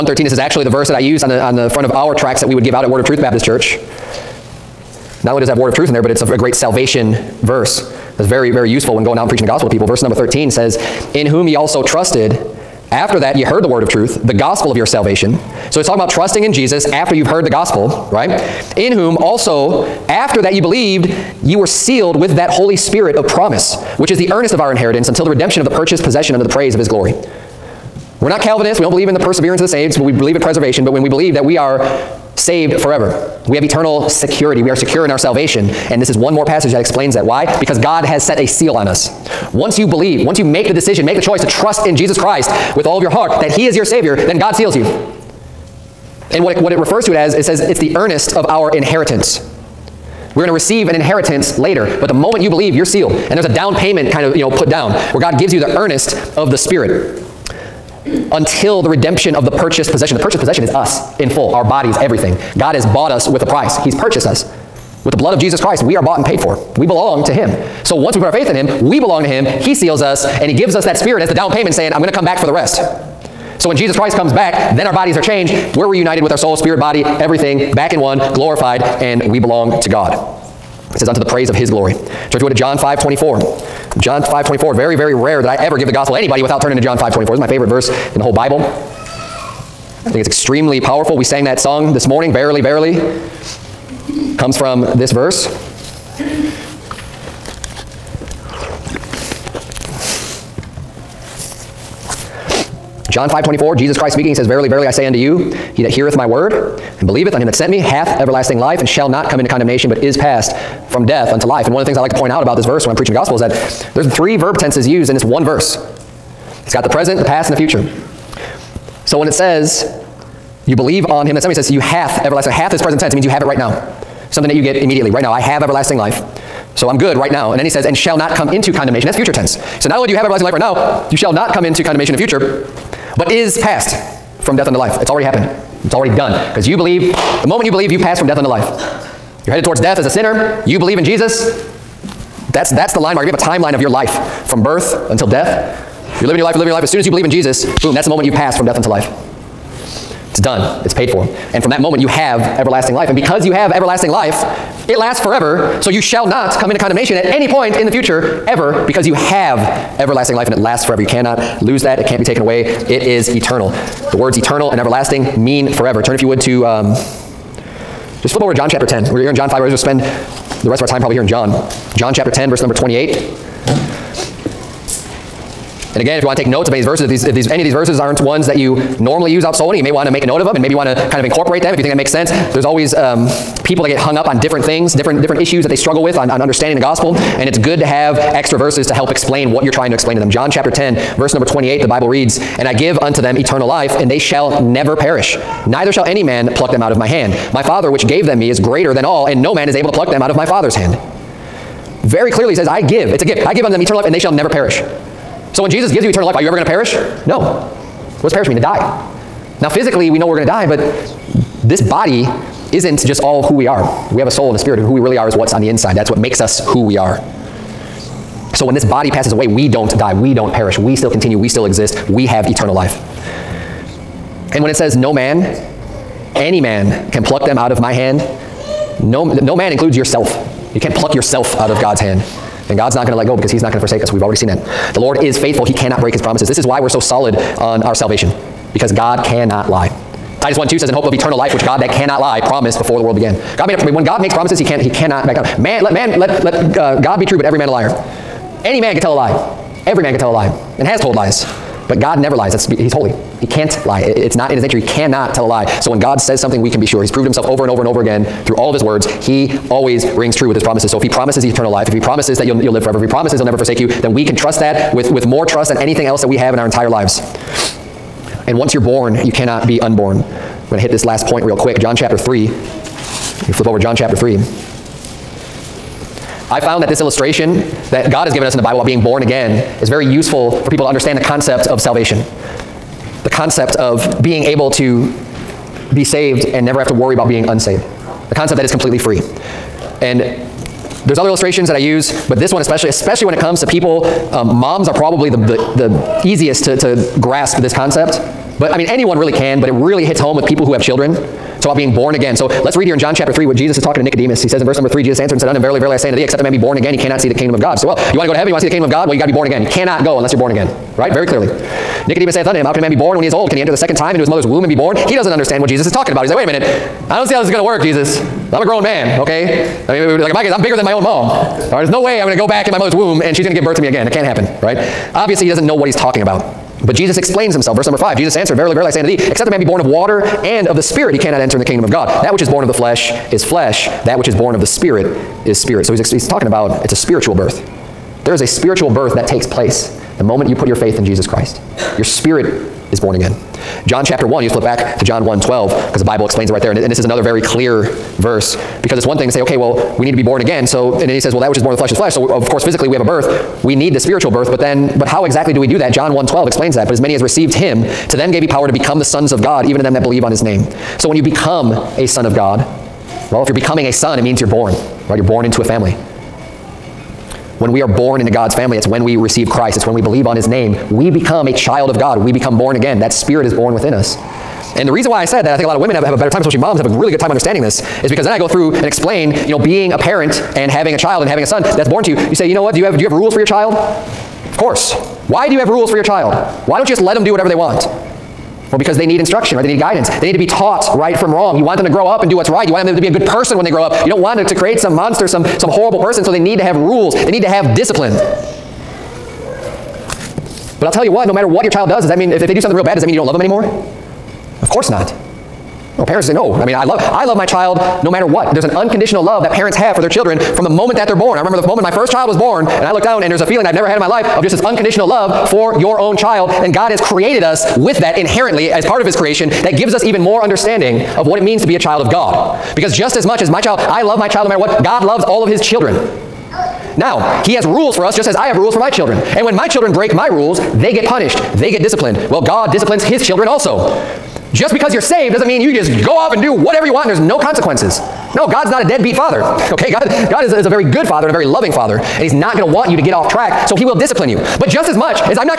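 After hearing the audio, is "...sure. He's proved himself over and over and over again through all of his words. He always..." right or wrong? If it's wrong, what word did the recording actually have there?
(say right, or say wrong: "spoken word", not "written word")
right.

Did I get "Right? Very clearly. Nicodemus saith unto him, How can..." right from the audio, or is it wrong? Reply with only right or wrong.
right.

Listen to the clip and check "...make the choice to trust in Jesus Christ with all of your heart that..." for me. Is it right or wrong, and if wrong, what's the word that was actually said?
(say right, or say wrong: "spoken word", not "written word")
right.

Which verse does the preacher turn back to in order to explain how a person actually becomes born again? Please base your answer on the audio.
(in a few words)
John 1:12.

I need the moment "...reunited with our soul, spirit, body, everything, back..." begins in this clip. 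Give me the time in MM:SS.
01:15.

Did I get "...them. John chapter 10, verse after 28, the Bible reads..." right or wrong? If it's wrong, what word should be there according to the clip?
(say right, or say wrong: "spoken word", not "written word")
wrong: "number", not "after".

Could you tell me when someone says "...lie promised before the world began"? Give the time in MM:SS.
04:02.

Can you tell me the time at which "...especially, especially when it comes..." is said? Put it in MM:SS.
04:52.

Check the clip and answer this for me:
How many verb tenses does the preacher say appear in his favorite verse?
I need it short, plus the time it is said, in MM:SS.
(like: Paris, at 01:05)
3, at 01:54.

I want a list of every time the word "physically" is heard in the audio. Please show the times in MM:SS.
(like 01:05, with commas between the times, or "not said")
03:29, 05:52.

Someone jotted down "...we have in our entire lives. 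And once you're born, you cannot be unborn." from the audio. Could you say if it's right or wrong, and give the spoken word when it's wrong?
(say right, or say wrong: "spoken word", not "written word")
right.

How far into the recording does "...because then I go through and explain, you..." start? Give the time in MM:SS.
06:18.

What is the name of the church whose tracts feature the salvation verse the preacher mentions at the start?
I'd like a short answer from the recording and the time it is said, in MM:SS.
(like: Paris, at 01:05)
Word of Truth Baptist Church, at 00:02.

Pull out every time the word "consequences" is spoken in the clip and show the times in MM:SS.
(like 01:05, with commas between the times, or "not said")
07:17.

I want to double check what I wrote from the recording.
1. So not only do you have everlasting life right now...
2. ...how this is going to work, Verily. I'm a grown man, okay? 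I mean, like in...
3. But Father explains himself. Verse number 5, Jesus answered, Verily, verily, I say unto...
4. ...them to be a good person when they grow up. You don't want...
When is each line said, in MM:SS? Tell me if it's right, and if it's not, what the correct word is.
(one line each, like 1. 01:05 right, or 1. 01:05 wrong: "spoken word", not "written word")
1. 02:09 right
2. 05:17 wrong: "Jesus", not "Verily"
3. 05:26 wrong: "Jesus", not "Father"
4. 06:32 right.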